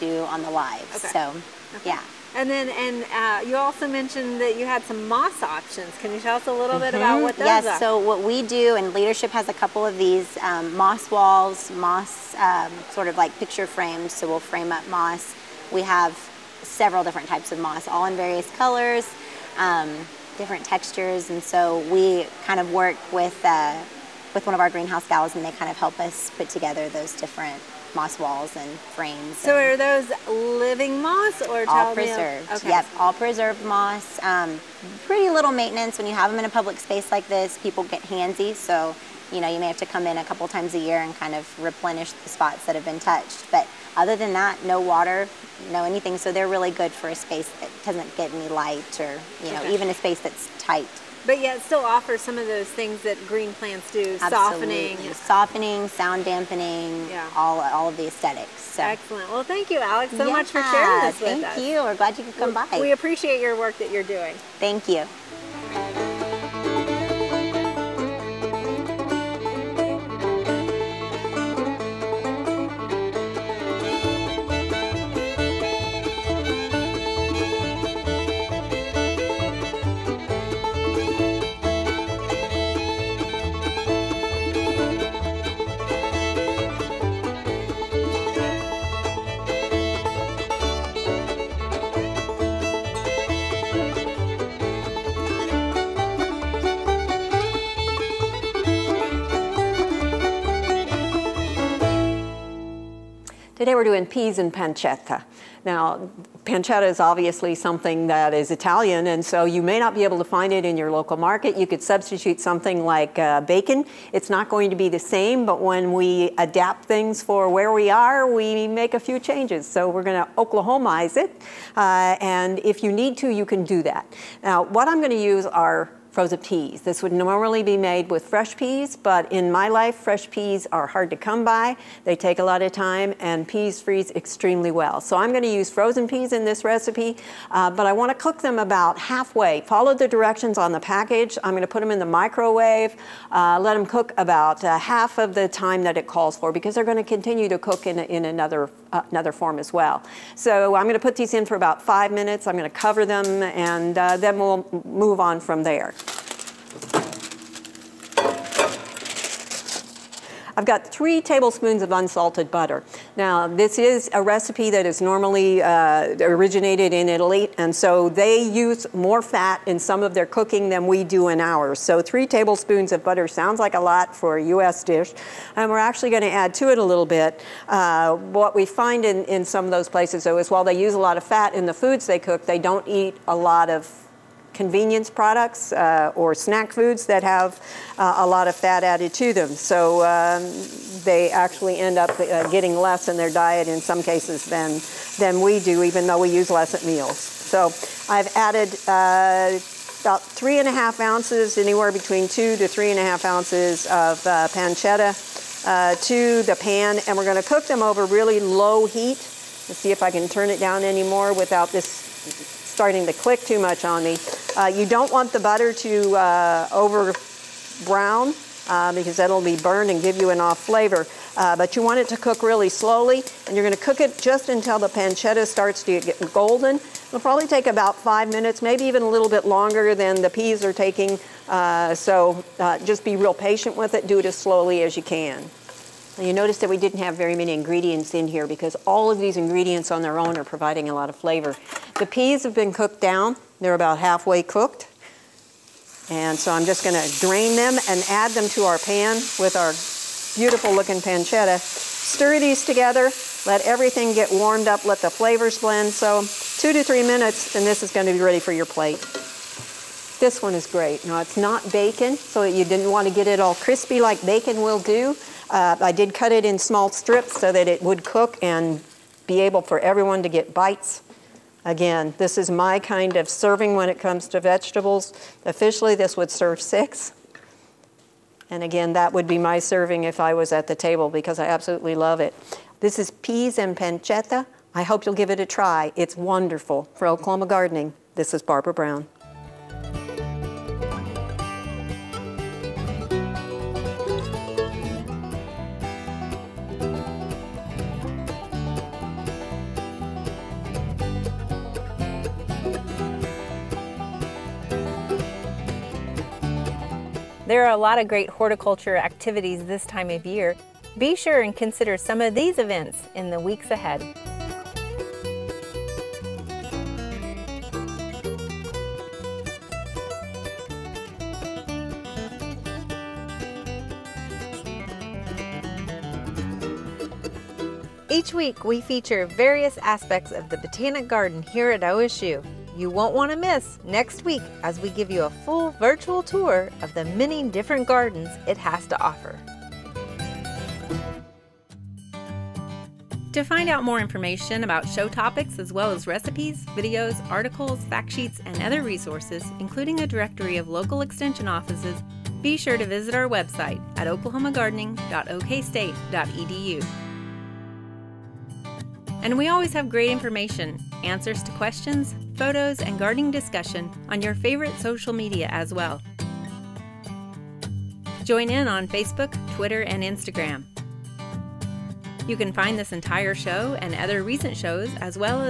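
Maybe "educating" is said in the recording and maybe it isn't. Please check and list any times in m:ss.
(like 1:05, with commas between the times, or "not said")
not said.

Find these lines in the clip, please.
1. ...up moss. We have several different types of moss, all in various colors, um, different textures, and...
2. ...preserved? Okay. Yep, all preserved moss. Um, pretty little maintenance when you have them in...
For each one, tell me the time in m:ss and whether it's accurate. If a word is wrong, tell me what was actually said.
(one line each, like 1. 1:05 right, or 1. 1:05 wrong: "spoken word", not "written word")
1. 0:14 right
2. 0:31 right.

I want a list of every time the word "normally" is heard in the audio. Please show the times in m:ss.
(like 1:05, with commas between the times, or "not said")
2:07, 2:45.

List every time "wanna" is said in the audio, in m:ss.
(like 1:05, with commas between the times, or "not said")
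2:17, 4:22.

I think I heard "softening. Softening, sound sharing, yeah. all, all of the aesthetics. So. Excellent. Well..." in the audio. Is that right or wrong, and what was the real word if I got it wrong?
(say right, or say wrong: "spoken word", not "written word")
wrong: "dampening", not "sharing".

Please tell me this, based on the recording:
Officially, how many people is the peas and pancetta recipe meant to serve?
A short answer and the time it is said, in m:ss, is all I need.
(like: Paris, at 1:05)
6, at 4:36.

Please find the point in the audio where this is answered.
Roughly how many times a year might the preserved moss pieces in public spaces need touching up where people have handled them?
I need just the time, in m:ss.
0:40.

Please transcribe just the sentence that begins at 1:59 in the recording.
So we're going to Oklahomize it, uh, and if you need to, you can do that.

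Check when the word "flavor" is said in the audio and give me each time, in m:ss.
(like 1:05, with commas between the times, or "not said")
3:40, 4:01, 4:15.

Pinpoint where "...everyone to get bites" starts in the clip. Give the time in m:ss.
4:29.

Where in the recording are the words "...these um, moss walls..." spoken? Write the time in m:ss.
0:10.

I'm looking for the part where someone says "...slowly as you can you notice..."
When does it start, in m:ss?
3:54.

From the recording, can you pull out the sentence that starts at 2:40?
I've got three tablespoons of unsalted butter.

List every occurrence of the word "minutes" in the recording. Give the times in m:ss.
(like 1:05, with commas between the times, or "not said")
2:32, 3:48, 4:17.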